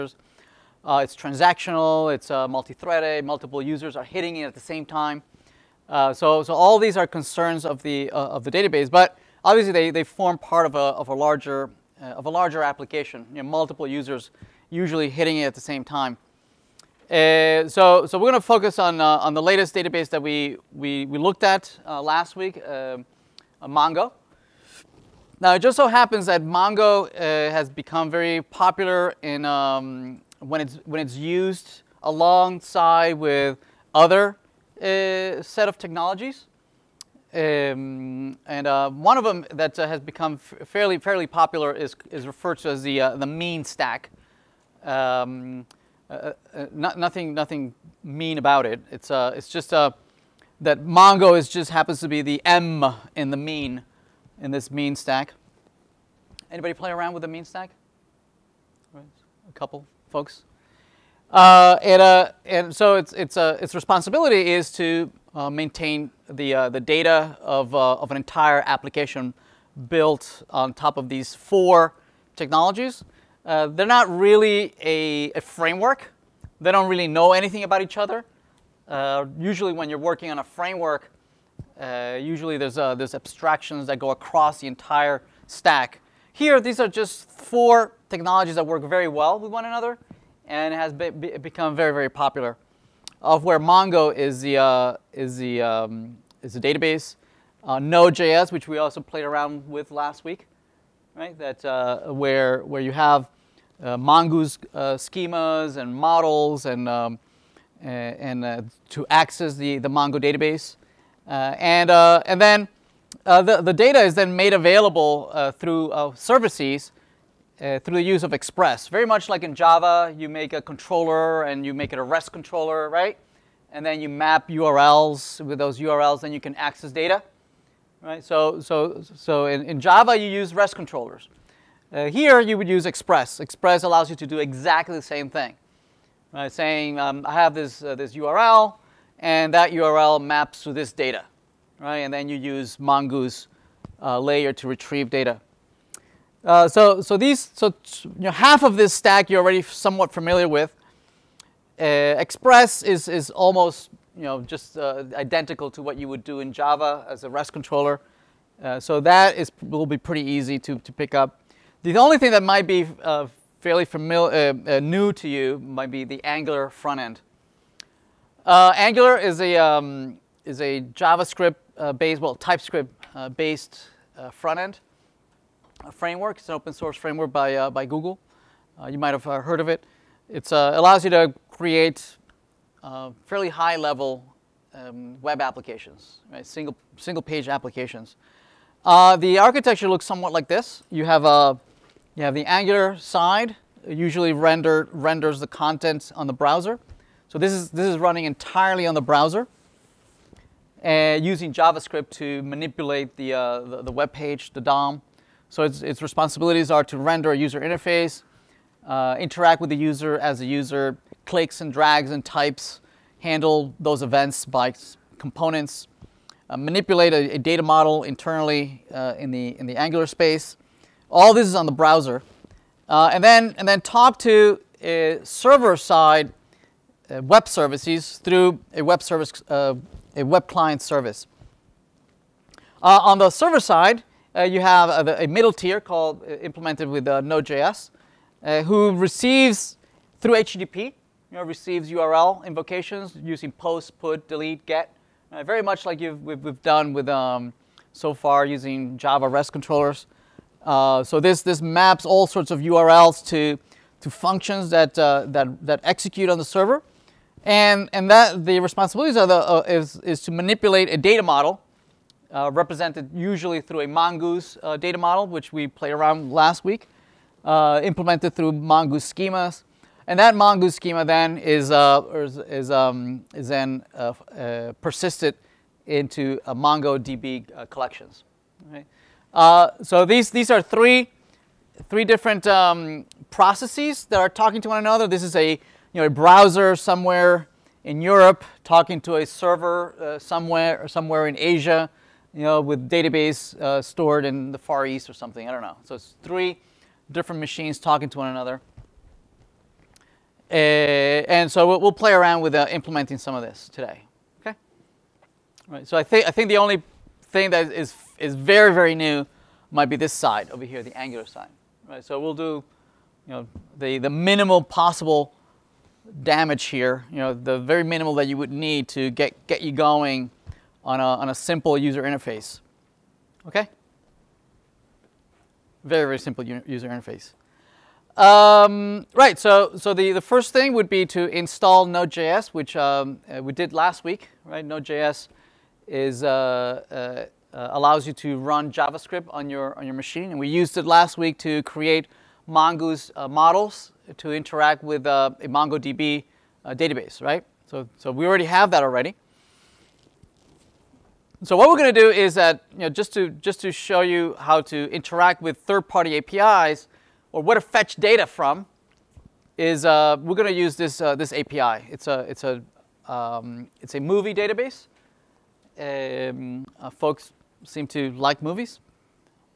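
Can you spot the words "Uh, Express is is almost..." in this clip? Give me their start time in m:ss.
2:31.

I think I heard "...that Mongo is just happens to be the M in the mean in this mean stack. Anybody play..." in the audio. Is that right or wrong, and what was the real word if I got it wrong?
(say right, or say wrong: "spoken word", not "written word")
right.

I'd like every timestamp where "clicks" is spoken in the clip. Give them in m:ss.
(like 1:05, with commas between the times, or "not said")
3:31.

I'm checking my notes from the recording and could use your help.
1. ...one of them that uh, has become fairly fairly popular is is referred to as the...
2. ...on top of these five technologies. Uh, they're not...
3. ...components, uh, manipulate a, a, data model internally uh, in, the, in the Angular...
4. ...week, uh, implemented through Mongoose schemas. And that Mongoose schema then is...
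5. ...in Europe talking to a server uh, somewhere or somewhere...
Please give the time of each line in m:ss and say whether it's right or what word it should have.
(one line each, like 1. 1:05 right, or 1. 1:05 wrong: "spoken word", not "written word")
1. 0:38 right
2. 1:10 wrong: "four", not "five"
3. 3:35 right
4. 4:26 right
5. 4:47 right.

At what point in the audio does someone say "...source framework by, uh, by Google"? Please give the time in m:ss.
2:56.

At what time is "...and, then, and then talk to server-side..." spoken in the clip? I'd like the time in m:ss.
3:43.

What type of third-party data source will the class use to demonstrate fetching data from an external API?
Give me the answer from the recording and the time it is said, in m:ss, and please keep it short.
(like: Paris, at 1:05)
movie database, at 6:03.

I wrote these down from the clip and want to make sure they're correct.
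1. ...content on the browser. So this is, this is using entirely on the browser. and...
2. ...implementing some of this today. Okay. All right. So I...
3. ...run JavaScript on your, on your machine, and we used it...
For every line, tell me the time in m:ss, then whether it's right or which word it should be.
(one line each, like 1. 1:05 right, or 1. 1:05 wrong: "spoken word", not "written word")
1. 3:15 wrong: "running", not "using"
2. 5:02 right
3. 5:38 right.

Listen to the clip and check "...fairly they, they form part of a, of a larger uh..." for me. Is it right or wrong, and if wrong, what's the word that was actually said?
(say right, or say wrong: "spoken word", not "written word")
wrong: "obviously", not "fairly".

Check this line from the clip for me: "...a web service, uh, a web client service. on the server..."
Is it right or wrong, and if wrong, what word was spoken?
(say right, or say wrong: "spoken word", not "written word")
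right.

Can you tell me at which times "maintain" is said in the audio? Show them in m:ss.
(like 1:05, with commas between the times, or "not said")
1:05.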